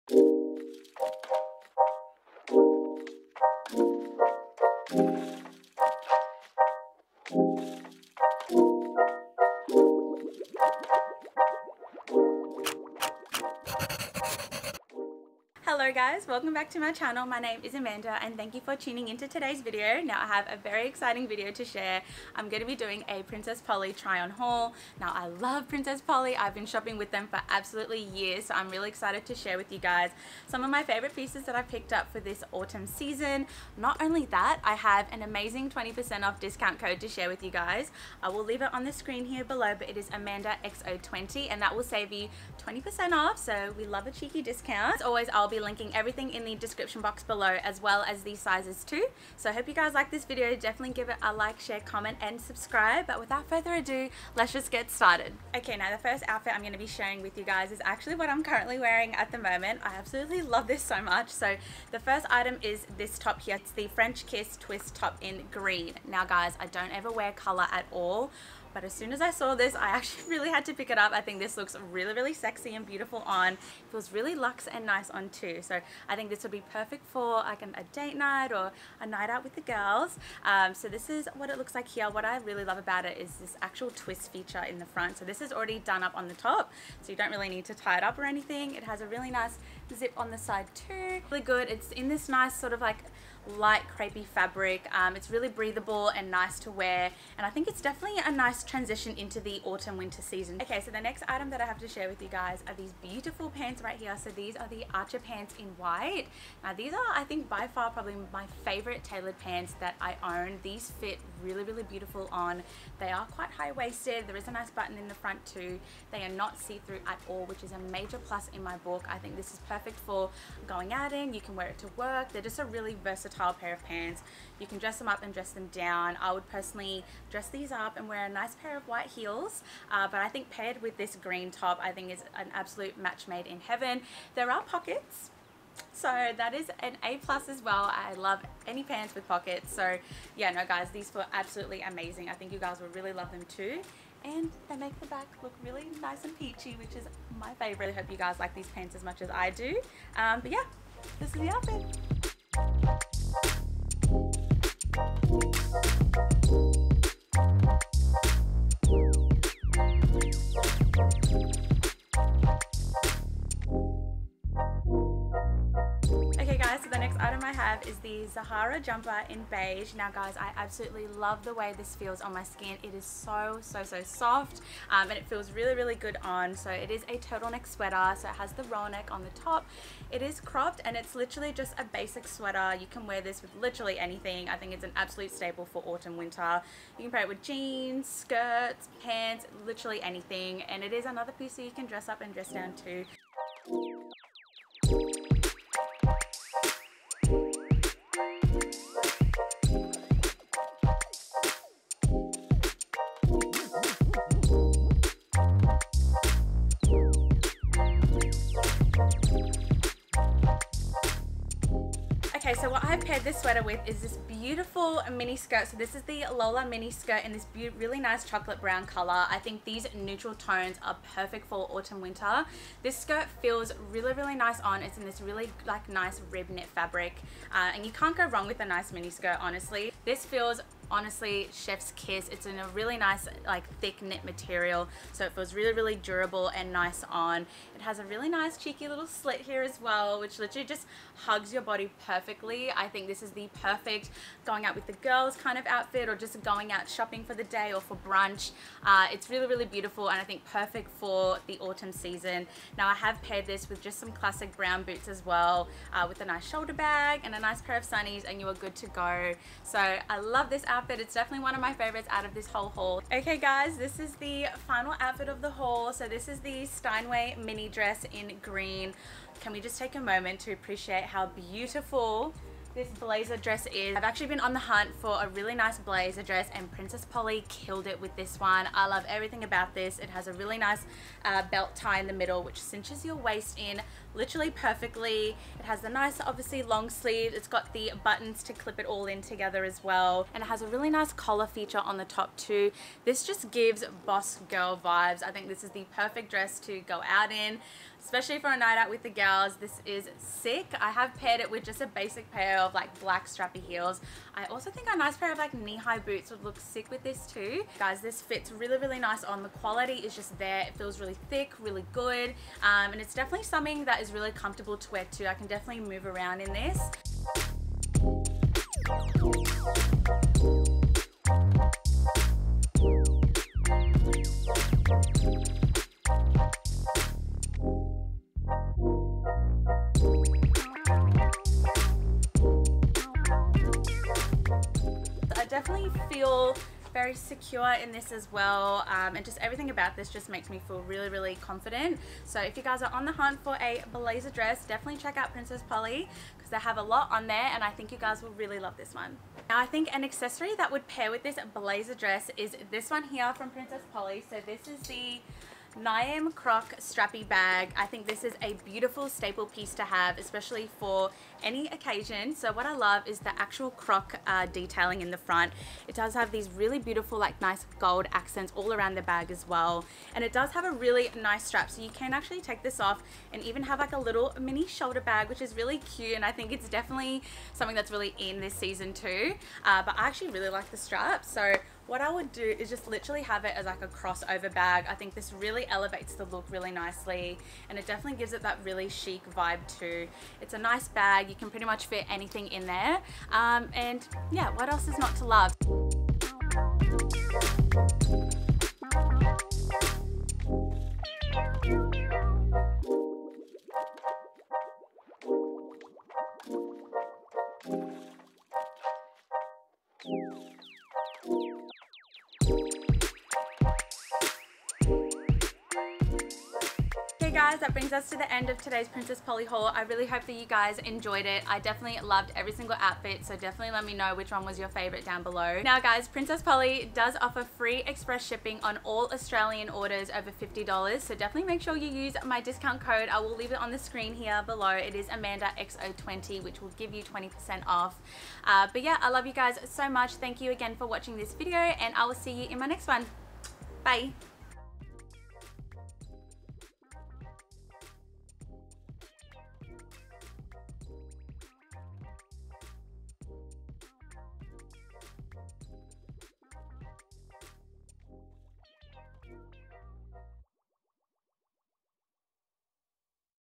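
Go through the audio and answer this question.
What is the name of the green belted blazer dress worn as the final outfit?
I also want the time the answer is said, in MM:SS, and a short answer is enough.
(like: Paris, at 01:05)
Steinway mini dress, at 04:26.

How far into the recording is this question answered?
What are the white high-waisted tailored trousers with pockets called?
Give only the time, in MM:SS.
01:44.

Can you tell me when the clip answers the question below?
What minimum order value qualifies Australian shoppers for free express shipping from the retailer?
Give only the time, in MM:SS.
07:10.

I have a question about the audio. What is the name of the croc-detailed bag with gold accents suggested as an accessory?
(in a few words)
Niamh Croc strappy bag.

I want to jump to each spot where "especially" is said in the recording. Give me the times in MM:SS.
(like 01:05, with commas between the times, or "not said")
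04:58, 06:00.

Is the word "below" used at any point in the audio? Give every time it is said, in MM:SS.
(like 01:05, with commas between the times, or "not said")
00:39, 00:47, 07:05, 07:14.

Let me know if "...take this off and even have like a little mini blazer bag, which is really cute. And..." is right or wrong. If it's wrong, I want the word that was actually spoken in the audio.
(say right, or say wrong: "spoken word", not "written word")
wrong: "shoulder", not "blazer".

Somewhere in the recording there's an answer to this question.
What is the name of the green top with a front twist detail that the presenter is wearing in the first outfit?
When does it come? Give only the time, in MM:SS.
01:03.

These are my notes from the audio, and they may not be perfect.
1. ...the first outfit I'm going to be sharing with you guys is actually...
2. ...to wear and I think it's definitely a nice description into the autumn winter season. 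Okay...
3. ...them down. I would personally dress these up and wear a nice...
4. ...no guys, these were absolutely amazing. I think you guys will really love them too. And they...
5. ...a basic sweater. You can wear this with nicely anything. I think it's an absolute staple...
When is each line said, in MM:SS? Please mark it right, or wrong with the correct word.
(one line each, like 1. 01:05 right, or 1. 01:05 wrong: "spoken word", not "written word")
1. 00:55 right
2. 01:36 wrong: "transition", not "description"
3. 02:05 right
4. 02:20 right
5. 03:01 wrong: "literally", not "nicely".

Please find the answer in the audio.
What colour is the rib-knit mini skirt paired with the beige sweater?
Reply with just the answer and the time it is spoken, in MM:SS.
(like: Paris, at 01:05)
Chocolate brown, at 03:38.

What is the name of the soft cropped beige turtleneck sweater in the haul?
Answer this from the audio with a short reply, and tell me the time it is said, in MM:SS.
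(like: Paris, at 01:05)
Zahara jumper, at 02:48.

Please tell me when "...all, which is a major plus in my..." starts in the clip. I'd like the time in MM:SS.
01:57.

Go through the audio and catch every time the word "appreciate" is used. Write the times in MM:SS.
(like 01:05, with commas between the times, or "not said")
04:30.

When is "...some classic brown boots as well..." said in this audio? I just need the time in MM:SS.
04:13.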